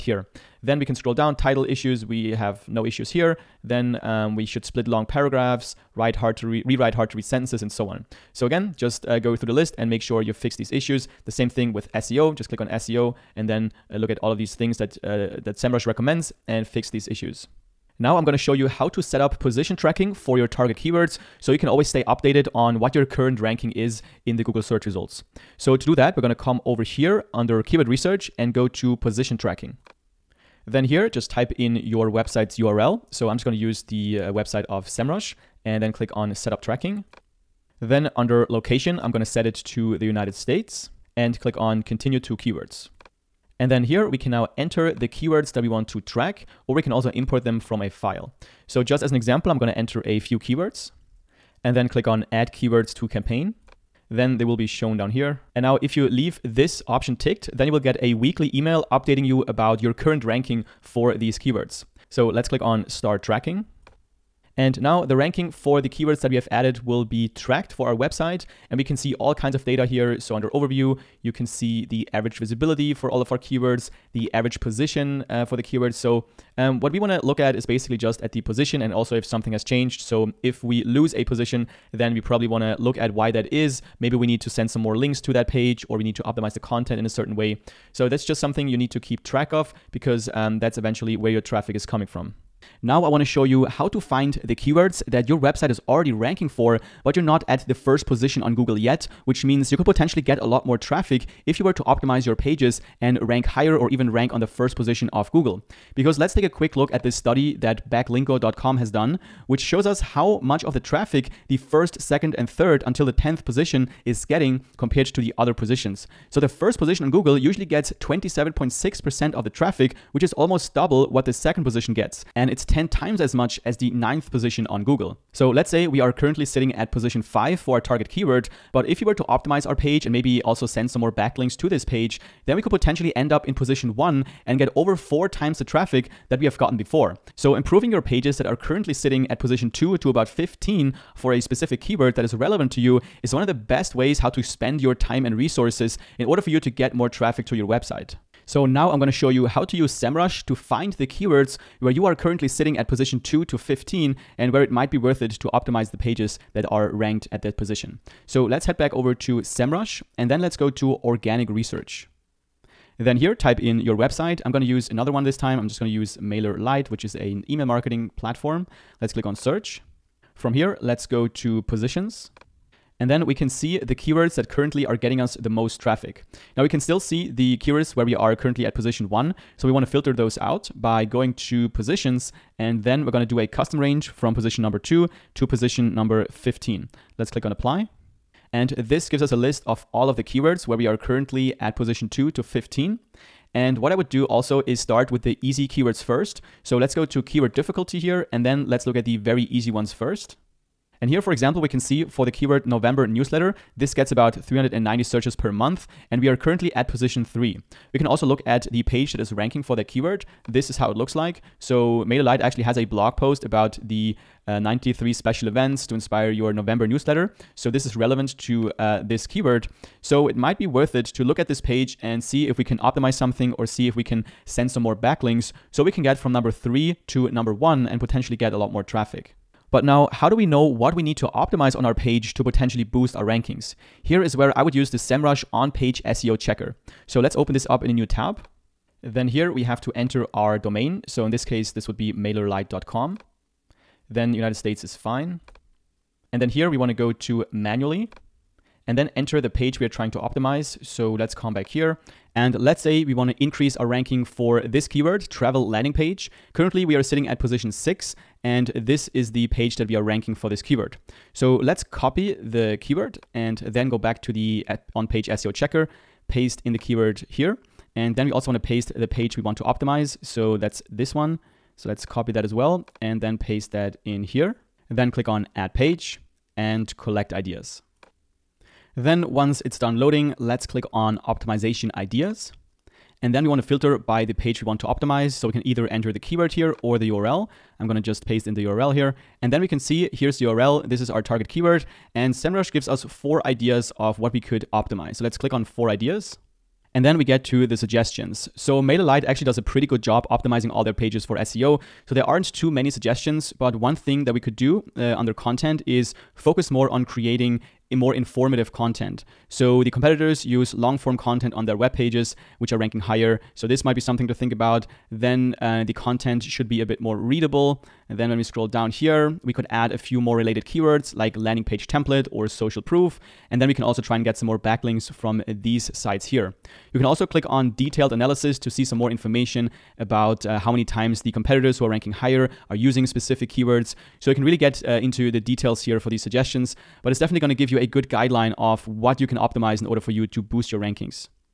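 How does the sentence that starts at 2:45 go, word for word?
I'm just gonna use MailerLite, which is an email marketing platform.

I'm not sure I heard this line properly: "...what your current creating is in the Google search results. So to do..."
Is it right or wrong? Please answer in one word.
wrong.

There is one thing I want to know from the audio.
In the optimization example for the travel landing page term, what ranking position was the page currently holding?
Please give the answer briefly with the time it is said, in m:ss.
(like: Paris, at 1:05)
6, at 4:17.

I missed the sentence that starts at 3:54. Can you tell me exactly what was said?
Here is where I would use the SEMrush on-page SEO checker.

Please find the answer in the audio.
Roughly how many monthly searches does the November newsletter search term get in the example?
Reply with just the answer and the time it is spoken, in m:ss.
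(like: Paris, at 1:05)
390, at 3:24.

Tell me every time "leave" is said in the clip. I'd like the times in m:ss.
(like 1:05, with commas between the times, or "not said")
0:56.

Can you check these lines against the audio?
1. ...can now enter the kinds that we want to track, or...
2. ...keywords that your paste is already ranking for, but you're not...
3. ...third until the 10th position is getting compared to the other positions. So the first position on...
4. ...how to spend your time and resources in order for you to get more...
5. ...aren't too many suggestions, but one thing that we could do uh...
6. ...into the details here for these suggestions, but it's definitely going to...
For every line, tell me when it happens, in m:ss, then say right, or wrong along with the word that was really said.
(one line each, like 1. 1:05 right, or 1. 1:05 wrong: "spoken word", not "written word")
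1. 0:44 wrong: "keywords", not "kinds"
2. 1:34 wrong: "website", not "paste"
3. 1:52 right
4. 2:24 right
5. 5:02 right
6. 5:35 right.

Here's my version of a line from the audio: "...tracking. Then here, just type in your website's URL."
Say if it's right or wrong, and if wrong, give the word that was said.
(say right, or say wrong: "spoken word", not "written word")
right.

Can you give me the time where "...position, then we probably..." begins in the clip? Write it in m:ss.
1:21.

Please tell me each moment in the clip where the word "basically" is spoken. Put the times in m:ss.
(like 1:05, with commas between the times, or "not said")
1:17.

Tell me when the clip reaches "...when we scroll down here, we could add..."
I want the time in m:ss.
5:18.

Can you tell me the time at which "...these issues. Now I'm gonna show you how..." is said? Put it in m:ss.
0:16.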